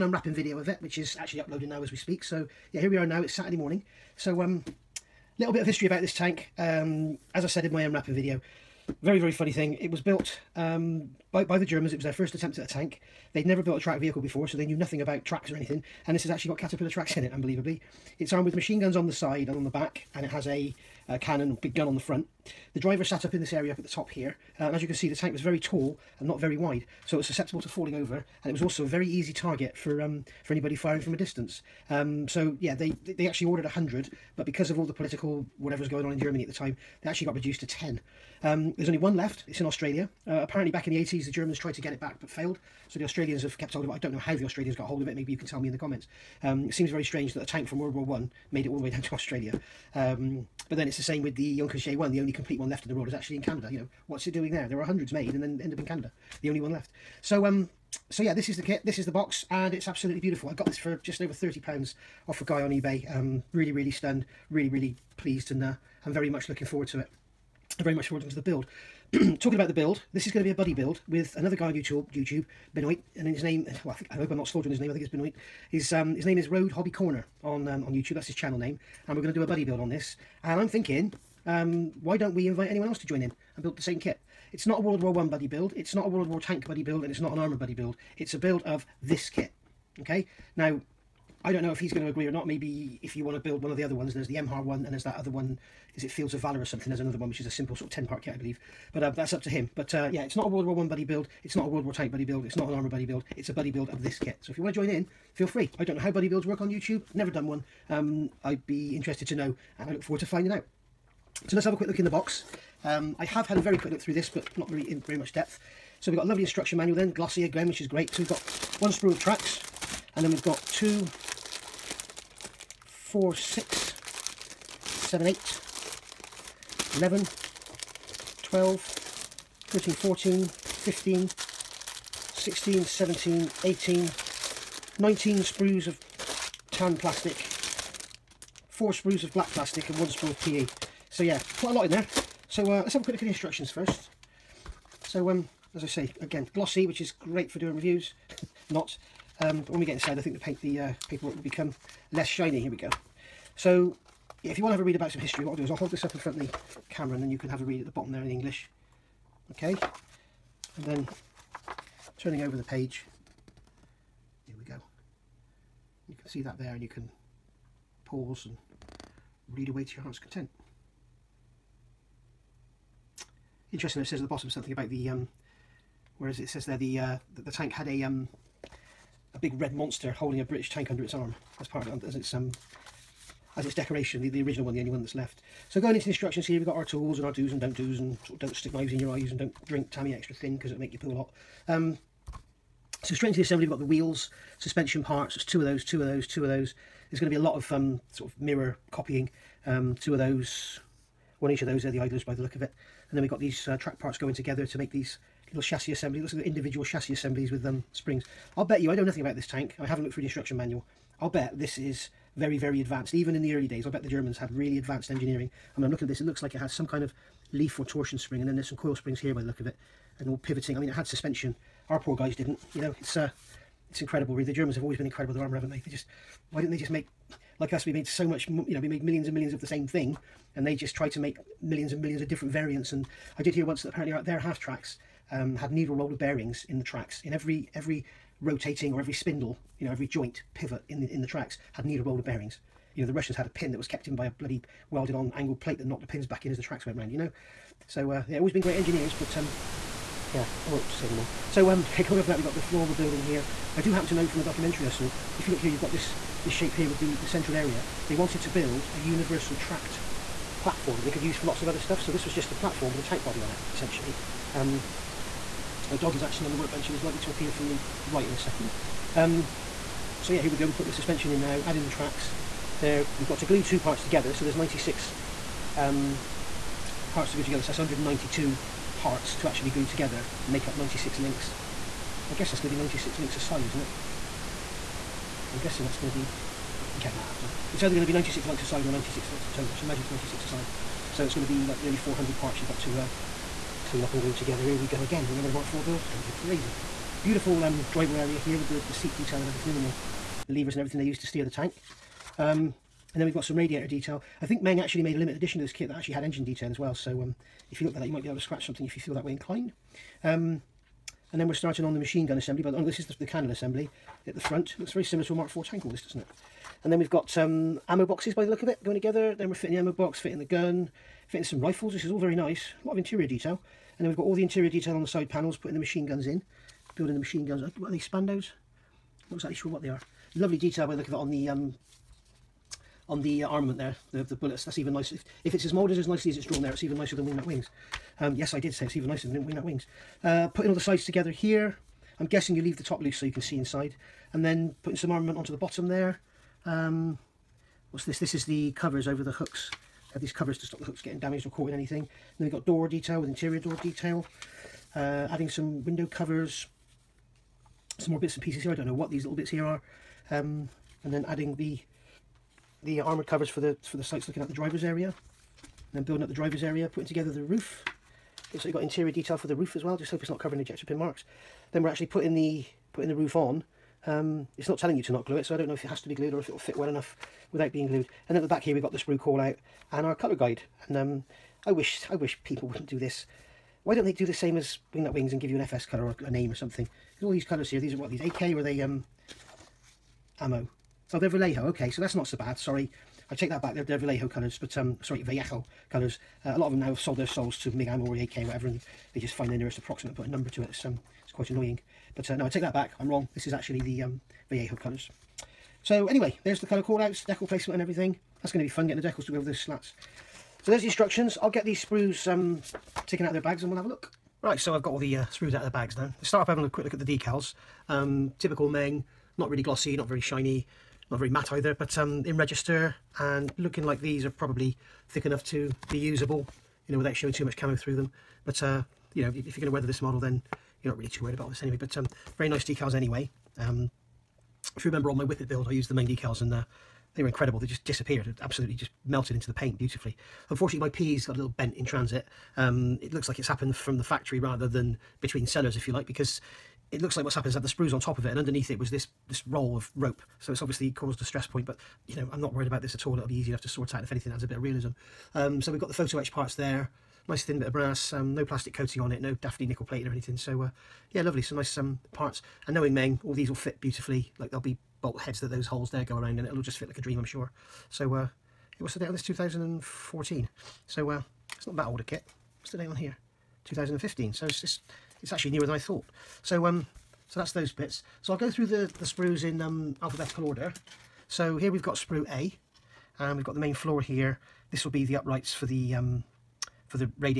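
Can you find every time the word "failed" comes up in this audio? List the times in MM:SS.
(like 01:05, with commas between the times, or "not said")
00:42.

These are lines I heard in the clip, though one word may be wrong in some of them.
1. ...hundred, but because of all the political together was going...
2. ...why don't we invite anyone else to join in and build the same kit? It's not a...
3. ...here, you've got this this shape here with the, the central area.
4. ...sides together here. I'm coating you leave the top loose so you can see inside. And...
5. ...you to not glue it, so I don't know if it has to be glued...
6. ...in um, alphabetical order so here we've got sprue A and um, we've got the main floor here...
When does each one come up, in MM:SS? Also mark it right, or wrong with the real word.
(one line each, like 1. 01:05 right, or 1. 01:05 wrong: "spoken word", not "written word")
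1. 00:33 wrong: "whatever", not "together"
2. 01:22 right
3. 04:15 right
4. 05:40 wrong: "guessing", not "coating"
5. 06:14 right
6. 07:59 right.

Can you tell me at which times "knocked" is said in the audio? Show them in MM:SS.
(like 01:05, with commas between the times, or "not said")
04:05.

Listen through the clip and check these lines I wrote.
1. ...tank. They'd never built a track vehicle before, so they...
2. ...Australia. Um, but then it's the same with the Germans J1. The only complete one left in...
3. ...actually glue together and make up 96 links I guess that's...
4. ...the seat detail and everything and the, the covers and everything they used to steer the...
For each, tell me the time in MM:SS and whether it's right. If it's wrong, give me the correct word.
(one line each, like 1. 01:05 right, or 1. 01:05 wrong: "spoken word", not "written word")
1. 00:12 right
2. 00:49 wrong: "Junkers", not "Germans"
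3. 04:39 right
4. 04:58 wrong: "levers", not "covers".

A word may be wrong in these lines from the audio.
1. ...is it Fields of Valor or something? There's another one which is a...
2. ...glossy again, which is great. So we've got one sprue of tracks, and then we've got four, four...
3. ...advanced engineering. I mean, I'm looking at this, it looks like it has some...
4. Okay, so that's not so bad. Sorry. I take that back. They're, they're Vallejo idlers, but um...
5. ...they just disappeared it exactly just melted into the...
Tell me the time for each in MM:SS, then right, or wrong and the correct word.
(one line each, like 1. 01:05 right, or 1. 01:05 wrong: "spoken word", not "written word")
1. 01:35 right
2. 01:57 wrong: "two", not "four"
3. 03:34 right
4. 06:31 wrong: "colours", not "idlers"
5. 07:17 wrong: "absolutely", not "exactly".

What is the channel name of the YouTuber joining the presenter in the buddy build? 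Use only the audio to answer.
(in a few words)
Road Hobby Corner.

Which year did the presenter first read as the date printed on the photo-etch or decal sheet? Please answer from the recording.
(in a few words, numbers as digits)
2014.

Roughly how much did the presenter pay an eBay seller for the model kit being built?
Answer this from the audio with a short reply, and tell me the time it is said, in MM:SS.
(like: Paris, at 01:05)
Just over £30, at 01:01.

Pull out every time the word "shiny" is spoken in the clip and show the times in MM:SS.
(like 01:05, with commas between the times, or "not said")
02:32, 07:00.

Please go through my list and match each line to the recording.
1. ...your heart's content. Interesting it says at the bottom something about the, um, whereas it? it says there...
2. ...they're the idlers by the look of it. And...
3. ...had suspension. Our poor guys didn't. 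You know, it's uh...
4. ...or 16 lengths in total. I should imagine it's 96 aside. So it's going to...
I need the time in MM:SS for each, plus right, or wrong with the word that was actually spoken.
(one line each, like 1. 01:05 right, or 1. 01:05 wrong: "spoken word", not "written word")
1. 02:49 right
2. 03:21 right
3. 03:40 right
4. 04:48 wrong: "96", not "16".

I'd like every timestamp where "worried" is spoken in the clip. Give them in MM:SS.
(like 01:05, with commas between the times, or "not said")
07:11, 07:32.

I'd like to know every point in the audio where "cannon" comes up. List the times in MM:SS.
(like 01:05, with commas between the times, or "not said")
00:21, 05:13.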